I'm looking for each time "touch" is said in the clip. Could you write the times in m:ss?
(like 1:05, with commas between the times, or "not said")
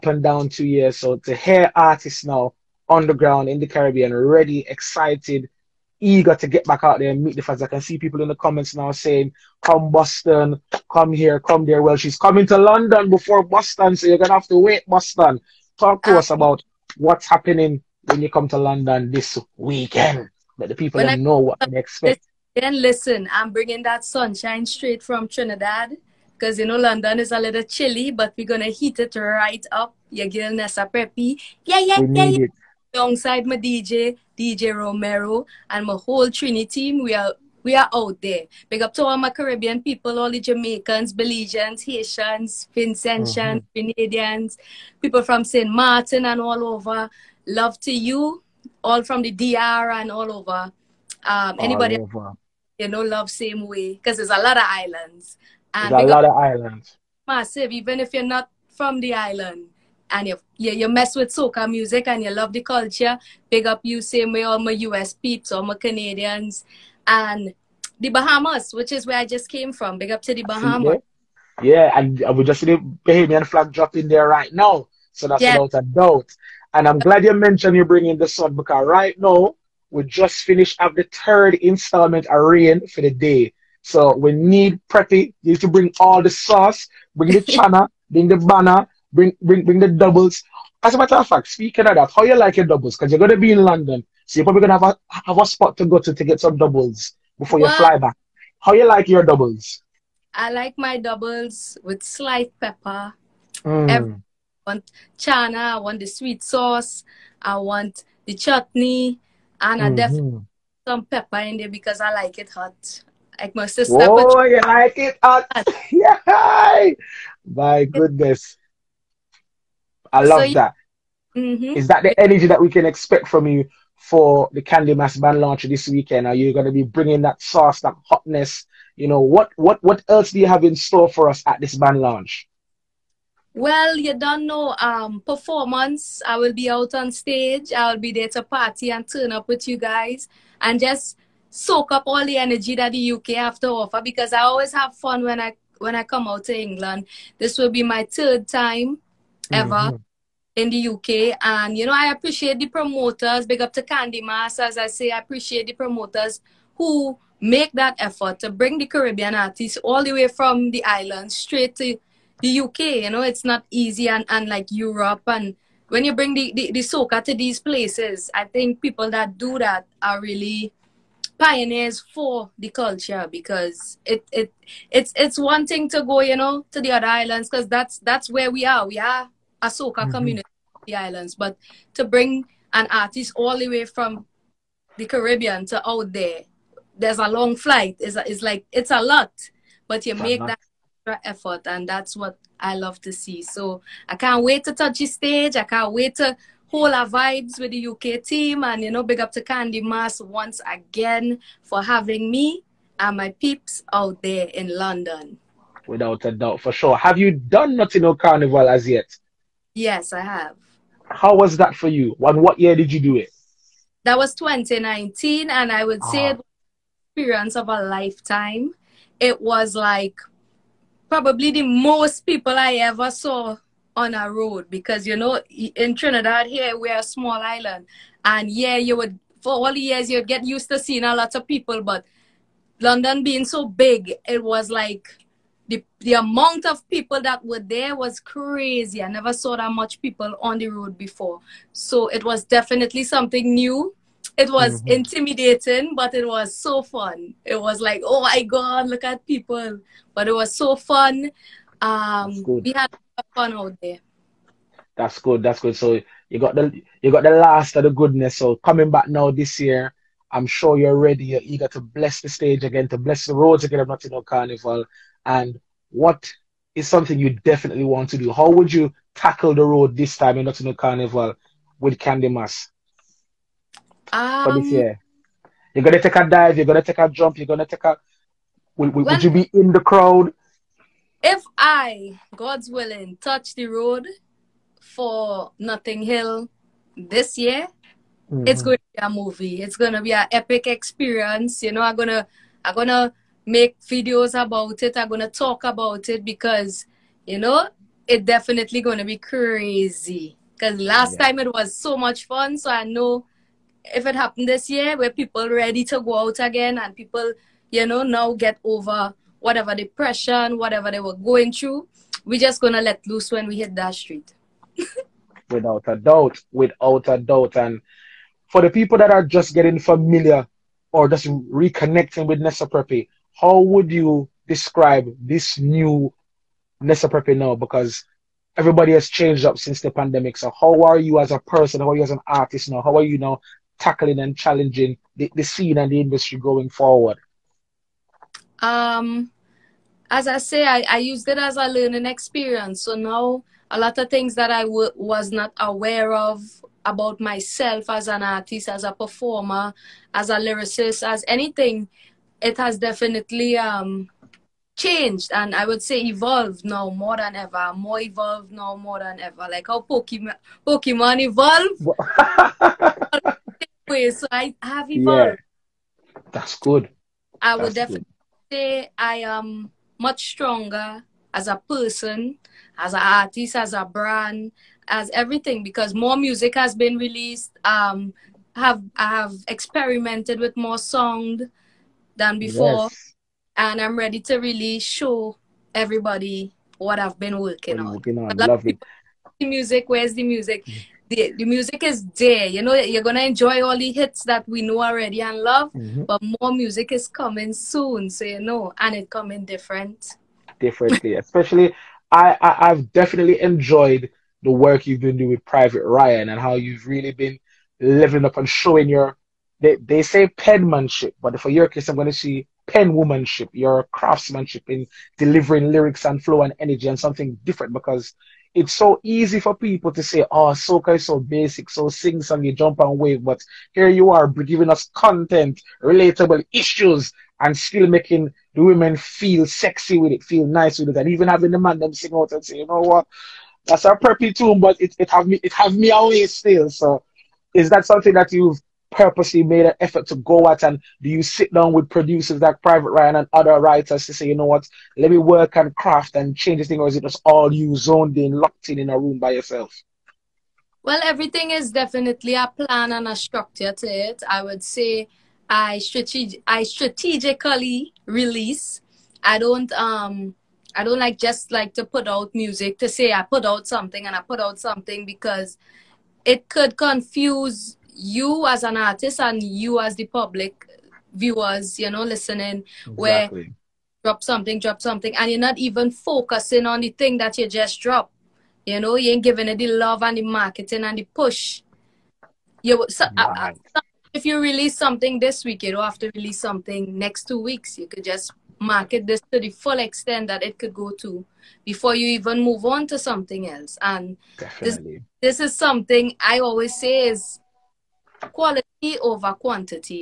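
3:14, 4:43.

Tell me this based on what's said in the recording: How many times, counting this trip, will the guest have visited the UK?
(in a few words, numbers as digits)
3.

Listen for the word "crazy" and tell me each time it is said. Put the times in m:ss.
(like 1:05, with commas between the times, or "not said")
3:58, 4:59.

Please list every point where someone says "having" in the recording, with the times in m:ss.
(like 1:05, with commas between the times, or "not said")
3:21, 7:11.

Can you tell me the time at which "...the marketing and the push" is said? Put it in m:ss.
8:00.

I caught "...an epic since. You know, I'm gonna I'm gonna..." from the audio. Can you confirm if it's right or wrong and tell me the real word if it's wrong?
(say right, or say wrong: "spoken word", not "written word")
wrong: "experience", not "since".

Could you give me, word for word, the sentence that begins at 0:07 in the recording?
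I can see people in the comments now saying, come Boston, come here, come there.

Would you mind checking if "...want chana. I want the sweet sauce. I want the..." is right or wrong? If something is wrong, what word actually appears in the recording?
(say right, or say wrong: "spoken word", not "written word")
right.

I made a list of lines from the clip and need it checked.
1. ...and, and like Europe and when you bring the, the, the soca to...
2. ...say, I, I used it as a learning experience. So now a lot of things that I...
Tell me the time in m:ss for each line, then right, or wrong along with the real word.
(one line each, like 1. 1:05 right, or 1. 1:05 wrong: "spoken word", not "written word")
1. 2:44 right
2. 5:40 right.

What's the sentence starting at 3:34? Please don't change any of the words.
That was 2019, and I would uh-huh.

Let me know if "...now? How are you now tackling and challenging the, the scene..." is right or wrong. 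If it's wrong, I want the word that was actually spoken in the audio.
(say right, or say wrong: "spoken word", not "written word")
right.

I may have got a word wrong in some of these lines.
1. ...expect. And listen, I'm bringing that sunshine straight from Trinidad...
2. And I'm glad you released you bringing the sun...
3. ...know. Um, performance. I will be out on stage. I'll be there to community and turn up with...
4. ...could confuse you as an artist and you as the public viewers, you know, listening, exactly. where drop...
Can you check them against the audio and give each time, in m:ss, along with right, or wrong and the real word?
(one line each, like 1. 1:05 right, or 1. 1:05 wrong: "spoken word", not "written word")
1. 0:21 right
2. 1:16 wrong: "mentioned", not "released"
3. 2:14 wrong: "party", not "community"
4. 7:46 right.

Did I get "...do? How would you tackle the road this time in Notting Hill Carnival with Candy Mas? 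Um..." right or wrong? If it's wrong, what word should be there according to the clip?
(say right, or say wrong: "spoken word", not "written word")
right.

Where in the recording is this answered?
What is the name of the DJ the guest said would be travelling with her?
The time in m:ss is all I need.
0:34.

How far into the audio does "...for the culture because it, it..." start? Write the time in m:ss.
2:51.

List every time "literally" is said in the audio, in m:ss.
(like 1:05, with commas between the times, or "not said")
not said.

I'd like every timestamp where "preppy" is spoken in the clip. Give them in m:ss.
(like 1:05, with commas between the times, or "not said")
0:30, 1:24, 5:22, 5:27, 7:13.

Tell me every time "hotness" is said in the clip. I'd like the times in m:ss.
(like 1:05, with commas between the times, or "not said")
2:08.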